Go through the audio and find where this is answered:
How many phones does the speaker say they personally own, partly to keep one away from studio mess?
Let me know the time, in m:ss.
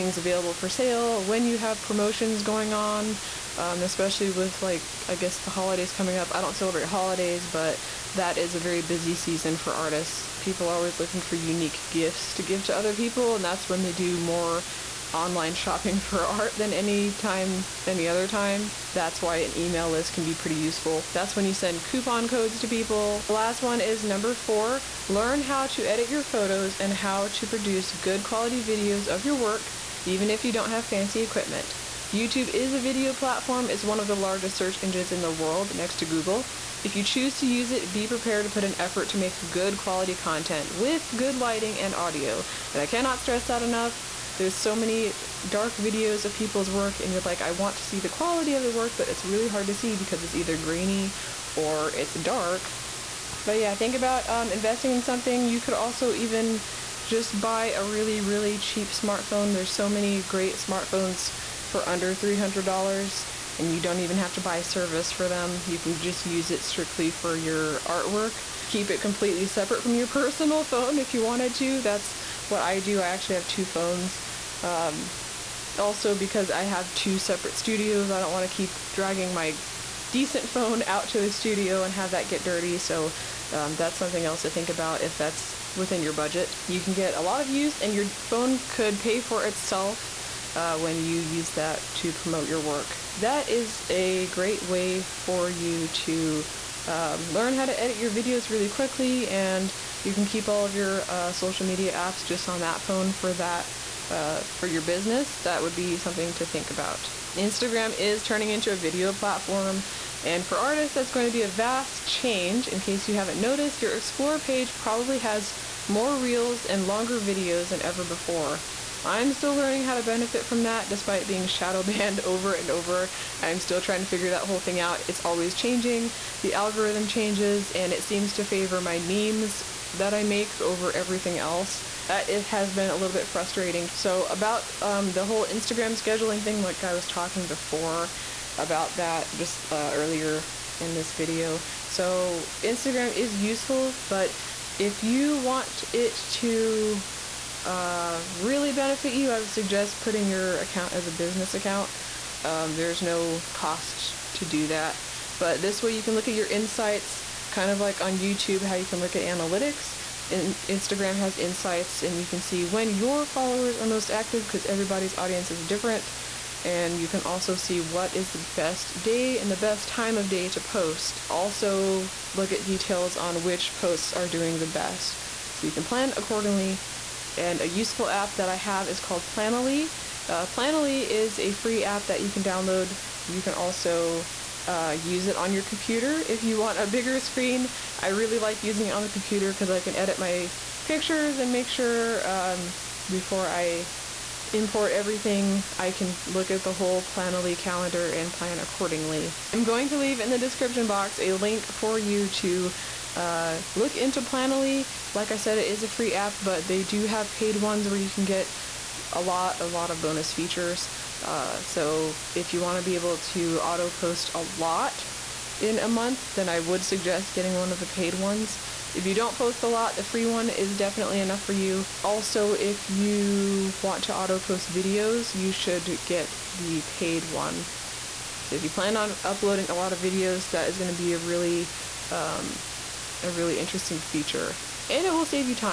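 1:13.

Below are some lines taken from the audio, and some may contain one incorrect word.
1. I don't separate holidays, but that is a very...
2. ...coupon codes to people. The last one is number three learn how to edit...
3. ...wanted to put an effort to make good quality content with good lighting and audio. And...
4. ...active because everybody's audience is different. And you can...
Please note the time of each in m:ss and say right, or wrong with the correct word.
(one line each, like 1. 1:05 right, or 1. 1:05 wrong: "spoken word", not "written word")
1. 0:06 wrong: "celebrate", not "separate"
2. 0:21 wrong: "four", not "three"
3. 0:38 wrong: "prepared", not "wanted"
4. 2:44 right.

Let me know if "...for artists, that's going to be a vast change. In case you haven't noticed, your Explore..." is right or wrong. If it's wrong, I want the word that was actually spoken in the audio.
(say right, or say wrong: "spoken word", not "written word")
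right.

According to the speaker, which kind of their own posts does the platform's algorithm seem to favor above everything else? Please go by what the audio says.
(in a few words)
Memes.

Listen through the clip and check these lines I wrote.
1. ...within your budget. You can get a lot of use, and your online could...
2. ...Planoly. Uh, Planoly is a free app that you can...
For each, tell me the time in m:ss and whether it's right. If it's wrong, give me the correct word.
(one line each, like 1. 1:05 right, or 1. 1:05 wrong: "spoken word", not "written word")
1. 1:25 wrong: "phone", not "online"
2. 2:59 right.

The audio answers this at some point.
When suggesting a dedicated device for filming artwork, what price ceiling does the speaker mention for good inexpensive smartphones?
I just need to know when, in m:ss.
1:02.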